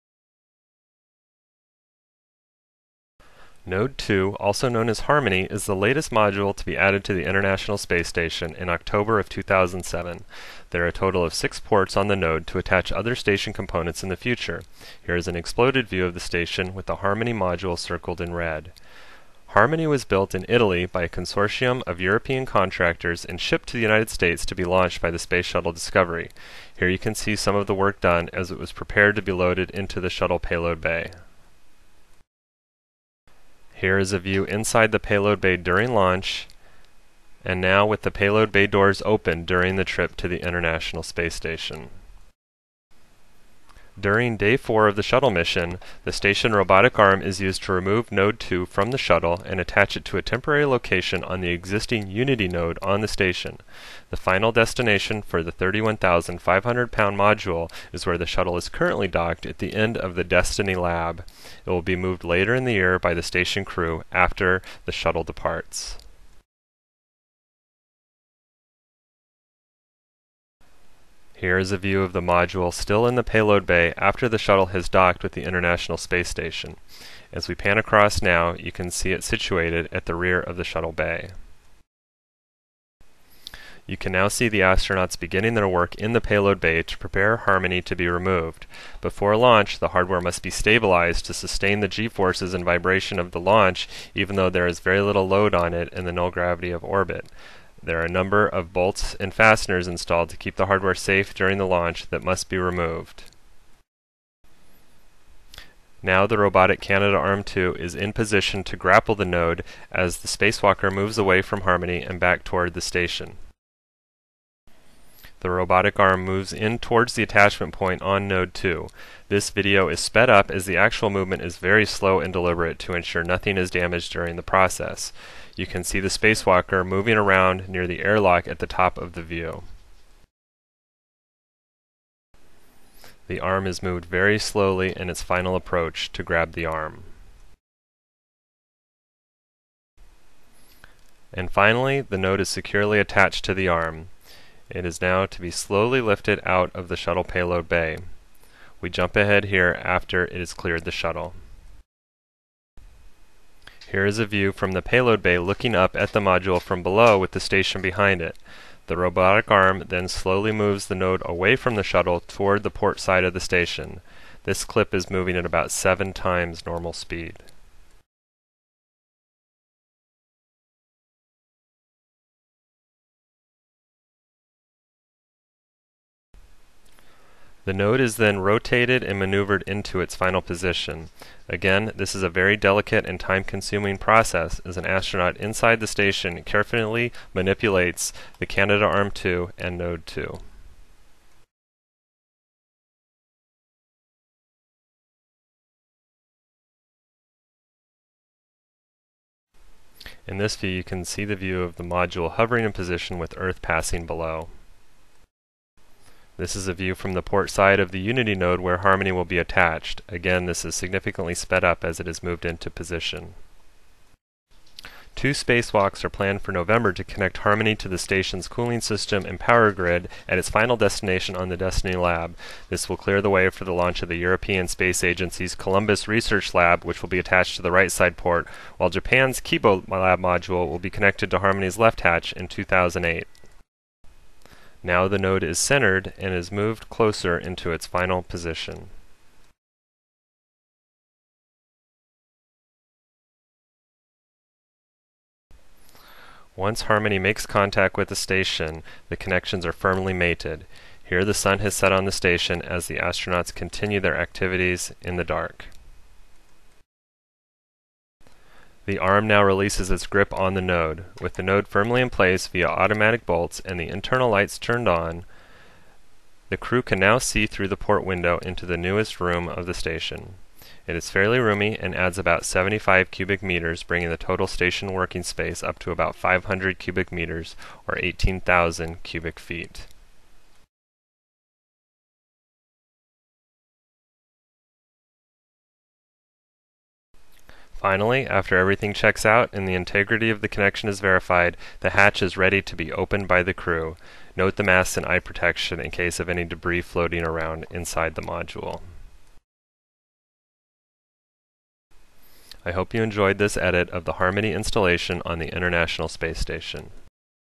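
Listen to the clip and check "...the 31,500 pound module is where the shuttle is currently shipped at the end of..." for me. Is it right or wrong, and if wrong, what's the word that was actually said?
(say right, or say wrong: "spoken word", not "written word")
wrong: "docked", not "shipped".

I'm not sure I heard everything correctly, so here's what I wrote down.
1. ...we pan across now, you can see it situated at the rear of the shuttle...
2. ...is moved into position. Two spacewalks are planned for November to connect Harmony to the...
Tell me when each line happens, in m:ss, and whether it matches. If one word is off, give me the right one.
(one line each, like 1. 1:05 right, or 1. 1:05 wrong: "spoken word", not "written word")
1. 1:17 right
2. 3:32 right.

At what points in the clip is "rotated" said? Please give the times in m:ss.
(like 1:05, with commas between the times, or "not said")
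2:58.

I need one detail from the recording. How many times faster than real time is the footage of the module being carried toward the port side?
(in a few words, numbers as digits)
7.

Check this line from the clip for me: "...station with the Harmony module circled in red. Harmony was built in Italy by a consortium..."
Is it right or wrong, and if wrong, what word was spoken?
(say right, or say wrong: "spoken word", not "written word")
right.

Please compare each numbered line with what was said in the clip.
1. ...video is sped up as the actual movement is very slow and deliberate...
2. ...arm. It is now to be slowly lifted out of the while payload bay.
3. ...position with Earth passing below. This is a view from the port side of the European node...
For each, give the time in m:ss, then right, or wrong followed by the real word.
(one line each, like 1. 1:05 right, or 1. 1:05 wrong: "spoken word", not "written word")
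1. 1:59 right
2. 2:23 wrong: "shuttle", not "while"
3. 3:22 wrong: "Unity", not "European".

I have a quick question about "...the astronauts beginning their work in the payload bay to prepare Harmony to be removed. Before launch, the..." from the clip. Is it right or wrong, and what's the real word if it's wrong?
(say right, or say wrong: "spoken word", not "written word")
right.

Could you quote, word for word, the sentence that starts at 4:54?
Note the masks and eye protection in case of any debris floating around inside the module.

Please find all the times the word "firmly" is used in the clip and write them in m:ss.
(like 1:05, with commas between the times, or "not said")
4:09, 4:21.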